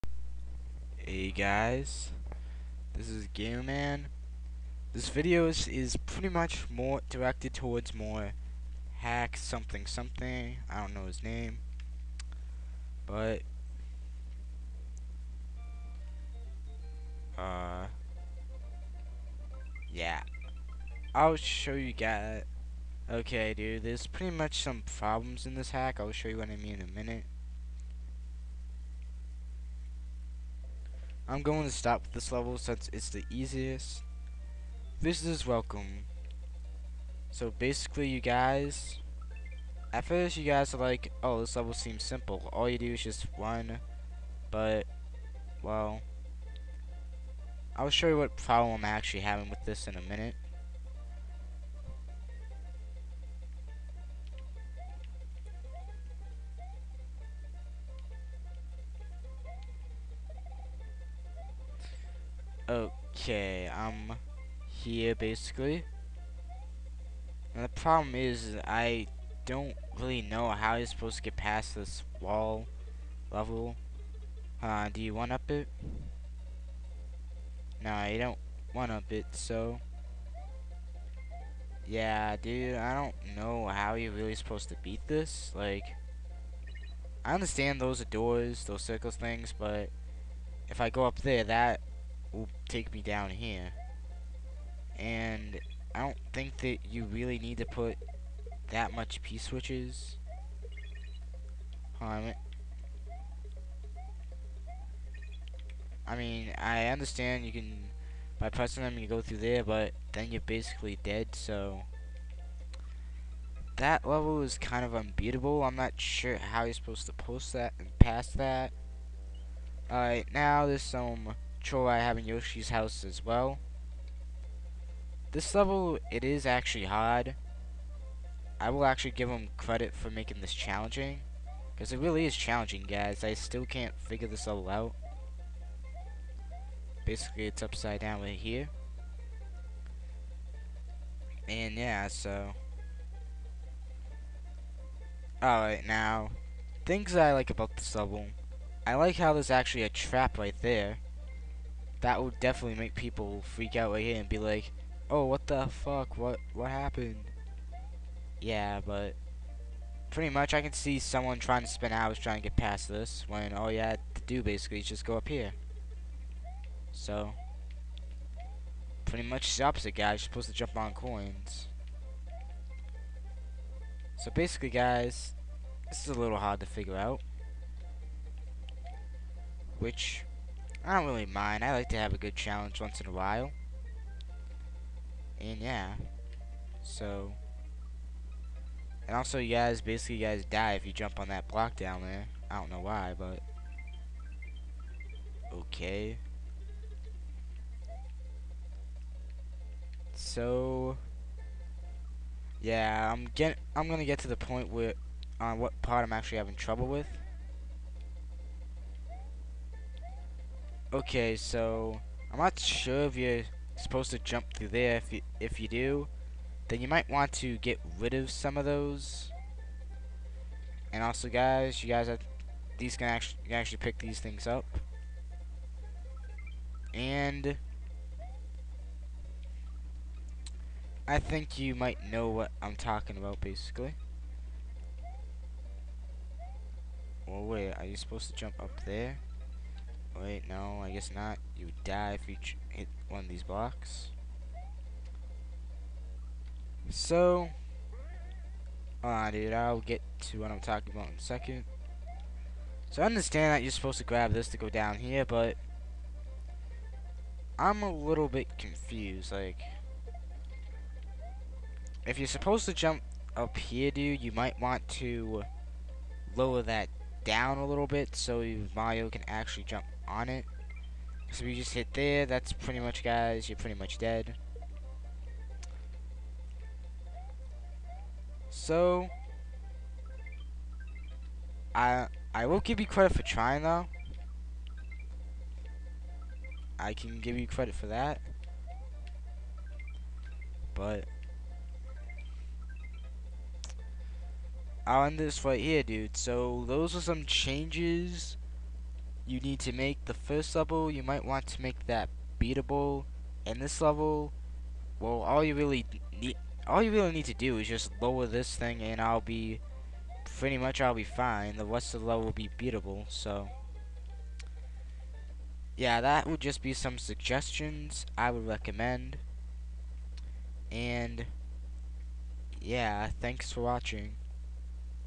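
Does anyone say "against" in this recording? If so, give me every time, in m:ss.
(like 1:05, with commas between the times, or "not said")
not said.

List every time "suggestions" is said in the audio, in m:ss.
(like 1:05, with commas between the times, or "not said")
5:16.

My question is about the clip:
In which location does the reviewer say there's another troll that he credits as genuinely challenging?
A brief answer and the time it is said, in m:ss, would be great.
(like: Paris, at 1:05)
Yoshi's house, at 2:02.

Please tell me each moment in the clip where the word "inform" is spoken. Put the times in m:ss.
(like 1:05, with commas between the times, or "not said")
not said.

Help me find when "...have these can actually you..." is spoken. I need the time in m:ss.
3:42.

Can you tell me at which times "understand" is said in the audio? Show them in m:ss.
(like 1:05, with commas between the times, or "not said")
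1:27, 1:46, 4:13.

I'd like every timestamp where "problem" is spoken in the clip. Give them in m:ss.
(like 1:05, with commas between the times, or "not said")
0:24, 0:48, 1:07.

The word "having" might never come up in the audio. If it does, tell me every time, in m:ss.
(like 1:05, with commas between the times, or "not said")
0:49, 3:26.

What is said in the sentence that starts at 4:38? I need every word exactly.
So, I I will give you credit for trying, though.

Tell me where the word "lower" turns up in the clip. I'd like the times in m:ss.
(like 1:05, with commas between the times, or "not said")
4:26, 5:08.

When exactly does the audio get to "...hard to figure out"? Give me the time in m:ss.
2:56.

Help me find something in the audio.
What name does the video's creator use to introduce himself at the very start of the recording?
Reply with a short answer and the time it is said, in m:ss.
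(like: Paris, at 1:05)
Gamer Man, at 0:03.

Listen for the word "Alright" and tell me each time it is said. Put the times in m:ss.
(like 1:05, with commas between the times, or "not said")
1:59, 2:25.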